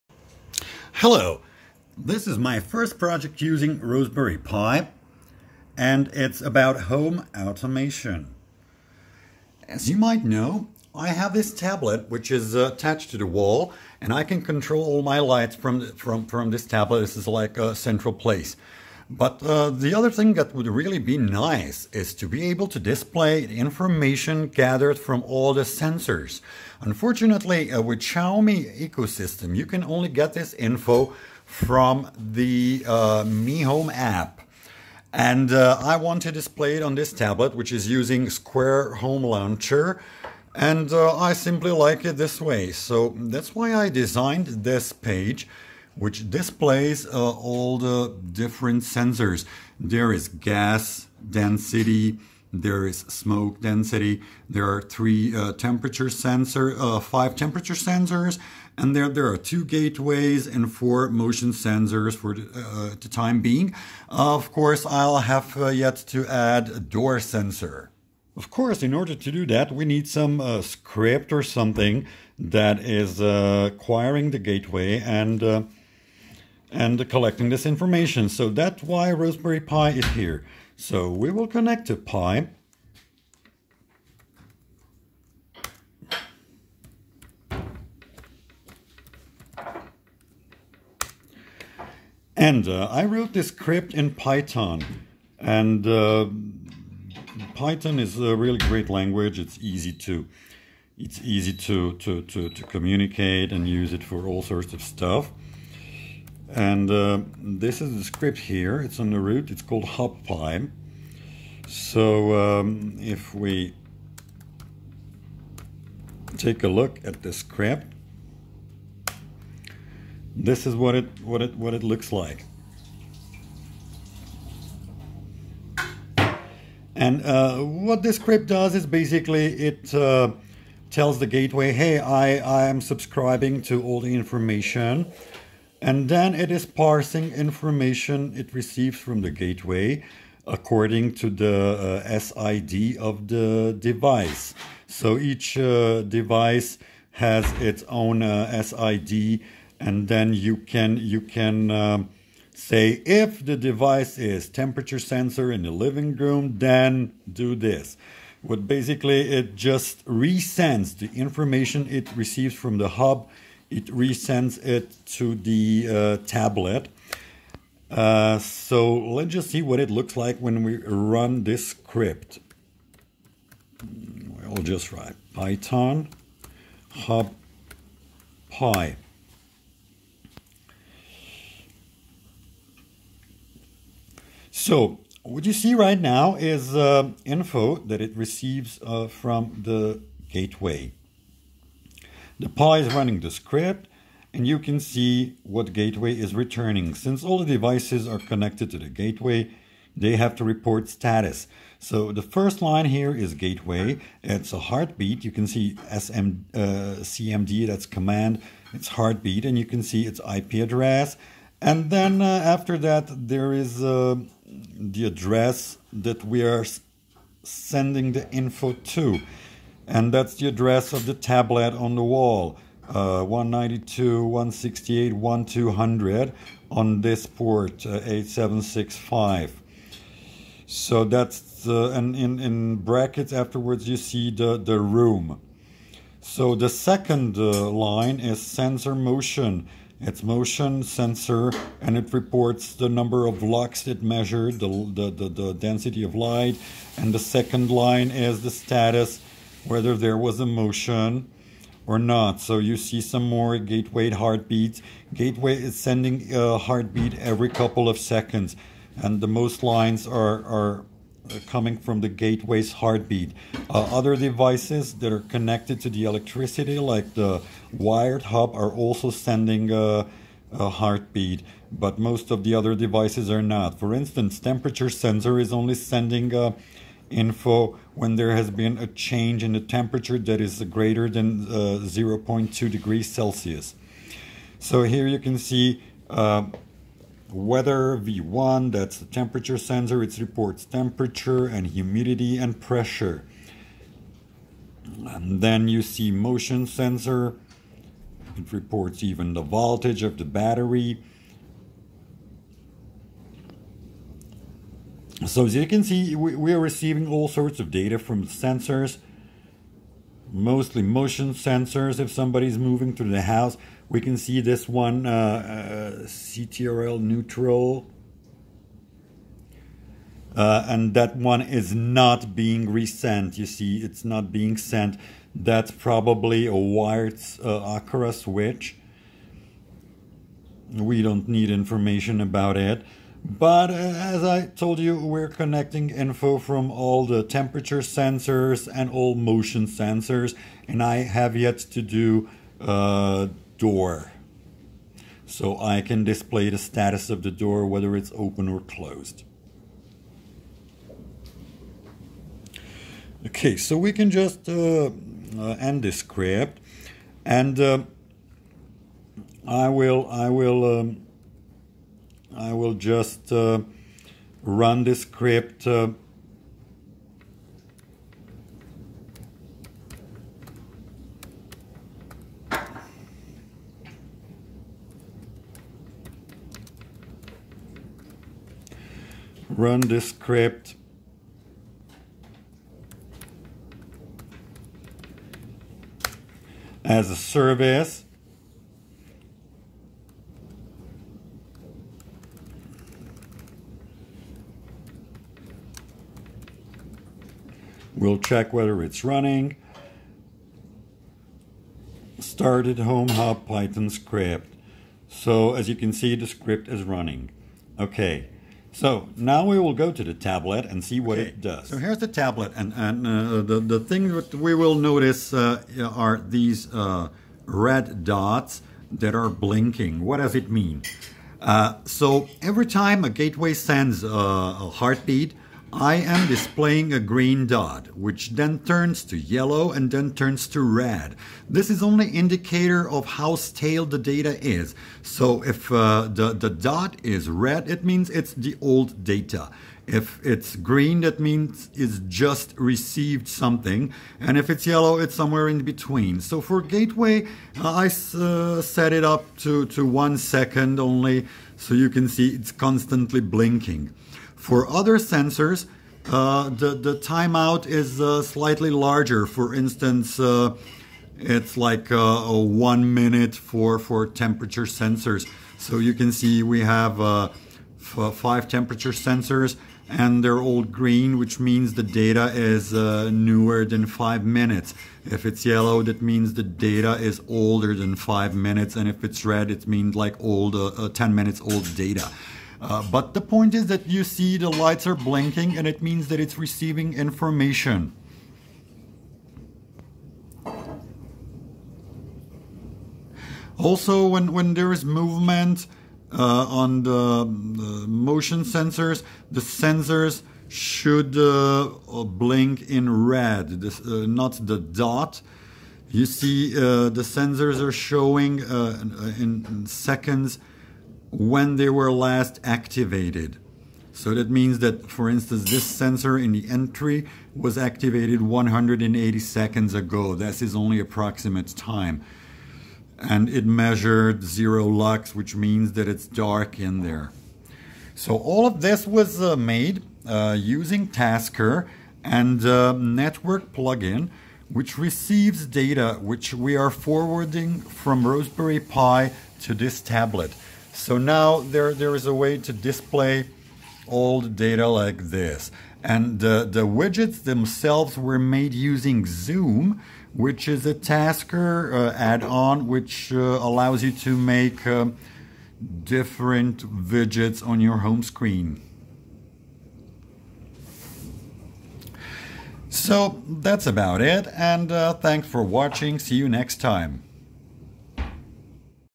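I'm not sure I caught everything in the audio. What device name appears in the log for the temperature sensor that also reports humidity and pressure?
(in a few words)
weather V1.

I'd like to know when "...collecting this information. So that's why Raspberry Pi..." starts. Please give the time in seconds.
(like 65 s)
77 s.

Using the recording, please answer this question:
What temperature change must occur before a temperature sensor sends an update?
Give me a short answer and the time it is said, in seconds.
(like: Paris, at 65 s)
0.2 degrees Celsius, at 281 s.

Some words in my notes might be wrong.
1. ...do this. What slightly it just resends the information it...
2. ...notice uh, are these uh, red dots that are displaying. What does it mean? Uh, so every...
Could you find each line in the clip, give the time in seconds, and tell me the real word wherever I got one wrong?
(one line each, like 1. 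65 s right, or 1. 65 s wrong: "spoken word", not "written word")
1. 157 s wrong: "basically", not "slightly"
2. 414 s wrong: "blinking", not "displaying".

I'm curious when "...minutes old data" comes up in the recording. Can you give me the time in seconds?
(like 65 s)
481 s.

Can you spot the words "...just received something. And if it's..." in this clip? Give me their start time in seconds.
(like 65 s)
441 s.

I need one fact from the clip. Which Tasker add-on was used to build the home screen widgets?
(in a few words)
Zoom.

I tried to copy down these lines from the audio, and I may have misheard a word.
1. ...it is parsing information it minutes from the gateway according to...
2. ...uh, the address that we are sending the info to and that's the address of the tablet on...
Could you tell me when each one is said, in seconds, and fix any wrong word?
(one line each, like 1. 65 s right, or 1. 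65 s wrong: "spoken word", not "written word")
1. 136 s wrong: "receives", not "minutes"
2. 213 s right.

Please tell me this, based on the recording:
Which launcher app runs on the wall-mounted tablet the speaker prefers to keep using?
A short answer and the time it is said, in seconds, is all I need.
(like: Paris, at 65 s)
Square Home Launcher, at 38 s.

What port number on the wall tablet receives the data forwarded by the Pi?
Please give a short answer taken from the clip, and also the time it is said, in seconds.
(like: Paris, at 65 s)
8765, at 228 s.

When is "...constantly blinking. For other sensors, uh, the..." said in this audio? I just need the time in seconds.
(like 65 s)
452 s.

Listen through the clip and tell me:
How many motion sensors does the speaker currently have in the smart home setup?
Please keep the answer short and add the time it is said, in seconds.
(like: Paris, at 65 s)
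4, at 60 s.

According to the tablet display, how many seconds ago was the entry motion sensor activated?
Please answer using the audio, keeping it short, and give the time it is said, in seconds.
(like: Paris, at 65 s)
180, at 518 s.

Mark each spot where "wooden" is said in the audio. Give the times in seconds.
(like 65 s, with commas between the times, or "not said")
not said.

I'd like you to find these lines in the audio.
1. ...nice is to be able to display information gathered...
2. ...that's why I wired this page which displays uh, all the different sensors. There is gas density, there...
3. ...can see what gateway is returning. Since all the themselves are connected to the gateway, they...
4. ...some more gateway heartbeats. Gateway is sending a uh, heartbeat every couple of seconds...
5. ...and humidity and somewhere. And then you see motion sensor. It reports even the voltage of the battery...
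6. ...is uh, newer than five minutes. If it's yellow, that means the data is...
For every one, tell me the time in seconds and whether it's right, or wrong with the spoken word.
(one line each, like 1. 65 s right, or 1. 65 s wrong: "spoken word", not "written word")
1. 21 s right
2. 43 s wrong: "designed", not "wired"
3. 194 s wrong: "devices", not "themselves"
4. 253 s right
5. 291 s wrong: "pressure", not "somewhere"
6. 472 s right.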